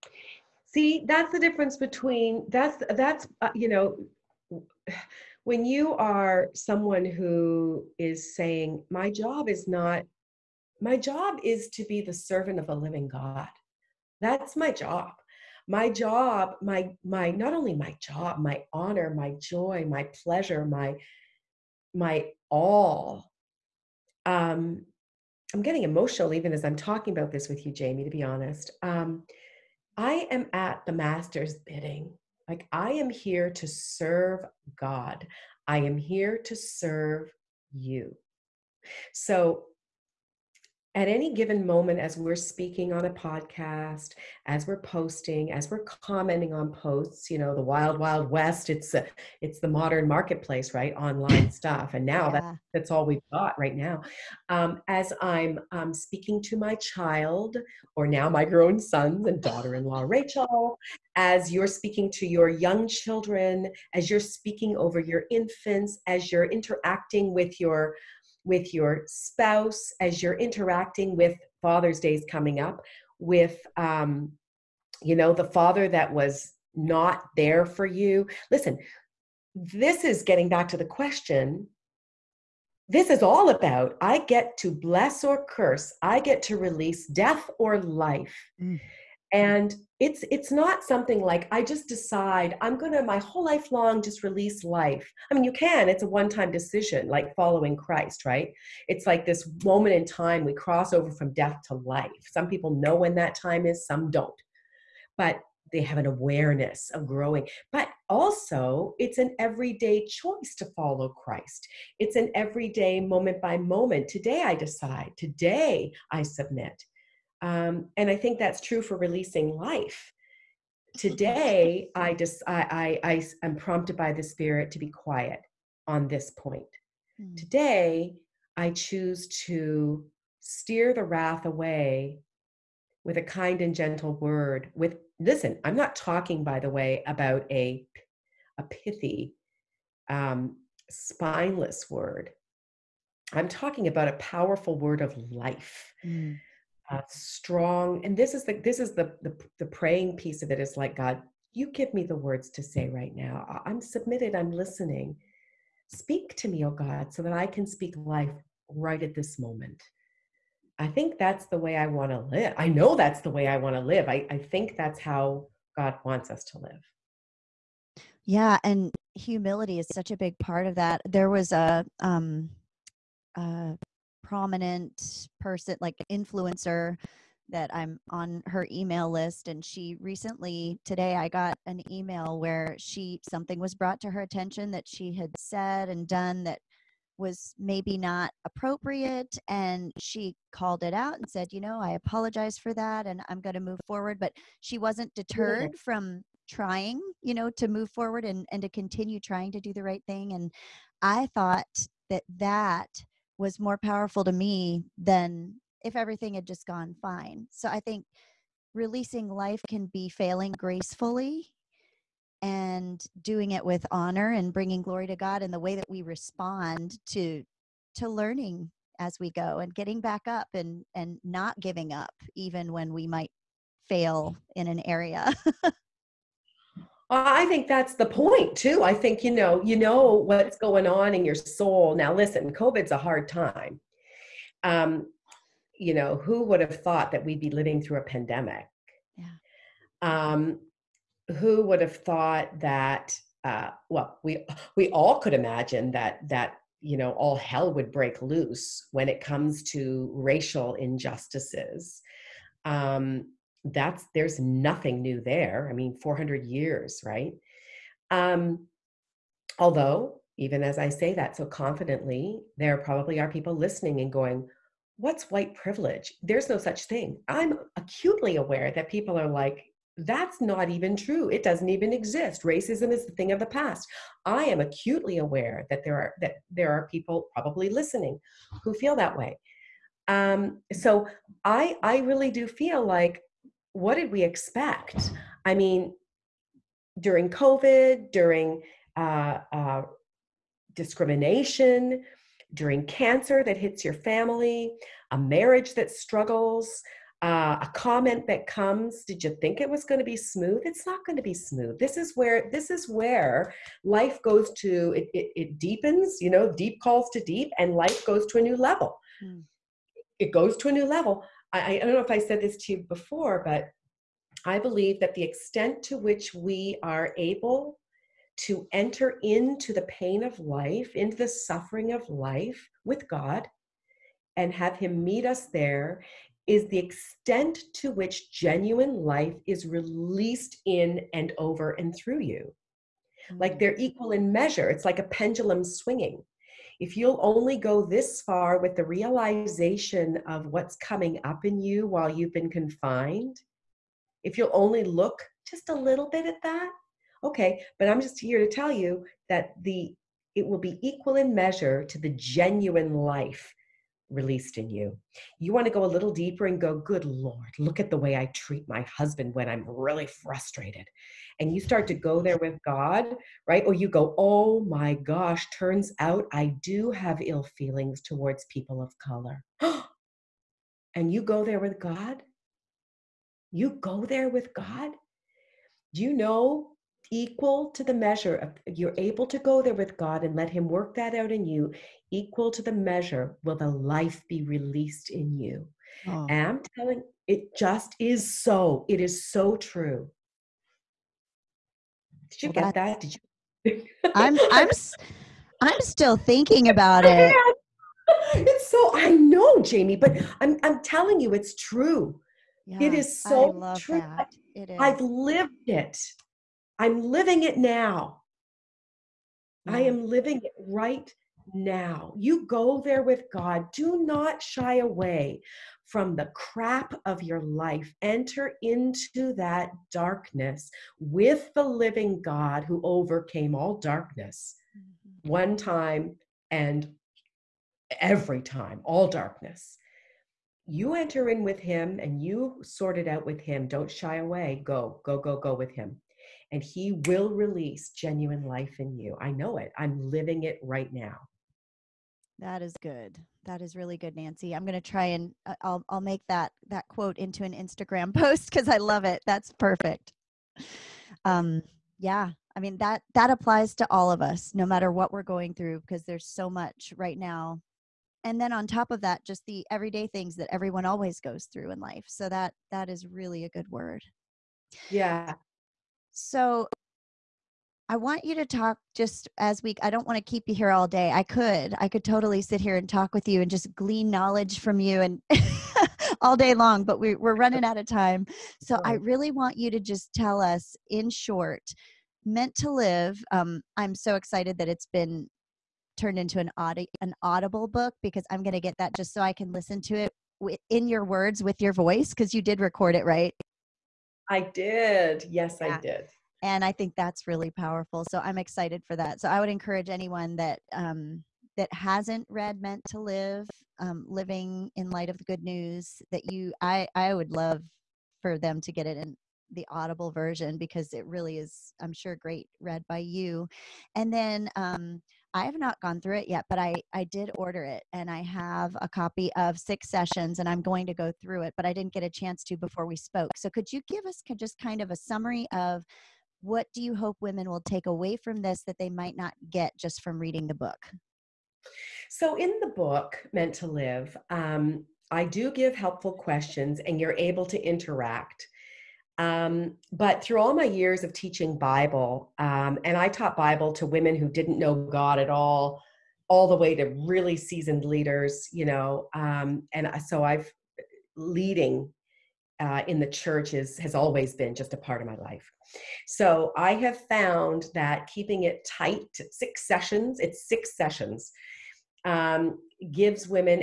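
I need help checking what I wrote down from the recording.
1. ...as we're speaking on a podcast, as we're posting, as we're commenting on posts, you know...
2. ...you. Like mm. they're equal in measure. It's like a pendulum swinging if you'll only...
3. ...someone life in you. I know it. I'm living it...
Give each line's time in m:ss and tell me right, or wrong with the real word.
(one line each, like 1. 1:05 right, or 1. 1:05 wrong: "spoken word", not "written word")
1. 0:41 right
2. 5:32 right
3. 7:17 wrong: "genuine", not "someone".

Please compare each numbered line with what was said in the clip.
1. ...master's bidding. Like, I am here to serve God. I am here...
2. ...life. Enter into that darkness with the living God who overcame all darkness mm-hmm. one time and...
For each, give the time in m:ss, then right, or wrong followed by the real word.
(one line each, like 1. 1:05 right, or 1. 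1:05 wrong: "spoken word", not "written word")
1. 0:30 right
2. 6:57 right.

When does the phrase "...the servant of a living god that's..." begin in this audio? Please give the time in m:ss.
0:12.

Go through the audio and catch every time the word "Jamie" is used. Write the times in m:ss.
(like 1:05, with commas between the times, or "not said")
0:27, 6:39.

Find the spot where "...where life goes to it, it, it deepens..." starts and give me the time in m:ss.
5:02.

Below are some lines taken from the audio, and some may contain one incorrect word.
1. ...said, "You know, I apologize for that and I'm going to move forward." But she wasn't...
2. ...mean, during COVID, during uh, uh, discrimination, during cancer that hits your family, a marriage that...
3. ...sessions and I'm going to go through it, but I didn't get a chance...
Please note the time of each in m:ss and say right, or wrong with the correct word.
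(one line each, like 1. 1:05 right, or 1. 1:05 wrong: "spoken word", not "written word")
1. 3:11 right
2. 4:45 right
3. 8:39 right.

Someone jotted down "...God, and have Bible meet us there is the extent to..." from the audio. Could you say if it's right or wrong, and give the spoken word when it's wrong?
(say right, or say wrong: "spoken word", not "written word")
wrong: "Him", not "Bible".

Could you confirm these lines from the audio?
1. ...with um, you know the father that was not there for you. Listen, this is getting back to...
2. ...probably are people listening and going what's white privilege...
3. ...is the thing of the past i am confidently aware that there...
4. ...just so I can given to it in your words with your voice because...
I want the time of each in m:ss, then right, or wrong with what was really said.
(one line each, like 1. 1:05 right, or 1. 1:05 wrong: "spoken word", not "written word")
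1. 1:13 right
2. 4:22 right
3. 4:32 wrong: "acutely", not "confidently"
4. 8:08 wrong: "listen", not "given".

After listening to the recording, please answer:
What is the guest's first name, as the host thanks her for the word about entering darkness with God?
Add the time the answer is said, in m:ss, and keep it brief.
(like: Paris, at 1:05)
Nancy, at 7:24.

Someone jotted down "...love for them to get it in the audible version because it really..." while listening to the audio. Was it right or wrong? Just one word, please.
right.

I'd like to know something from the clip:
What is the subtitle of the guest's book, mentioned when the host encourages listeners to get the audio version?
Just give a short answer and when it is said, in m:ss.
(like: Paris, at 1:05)
Living in Light of the Good News, at 8:24.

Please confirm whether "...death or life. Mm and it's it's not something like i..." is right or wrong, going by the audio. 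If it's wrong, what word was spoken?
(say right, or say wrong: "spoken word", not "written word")
right.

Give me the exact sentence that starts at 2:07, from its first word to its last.
Today, I choose to steer the wrath away with a kind and gentle word.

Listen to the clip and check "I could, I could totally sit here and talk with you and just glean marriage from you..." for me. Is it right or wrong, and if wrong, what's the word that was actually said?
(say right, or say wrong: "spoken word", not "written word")
wrong: "knowledge", not "marriage".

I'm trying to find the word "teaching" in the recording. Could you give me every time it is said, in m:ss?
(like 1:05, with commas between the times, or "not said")
9:01.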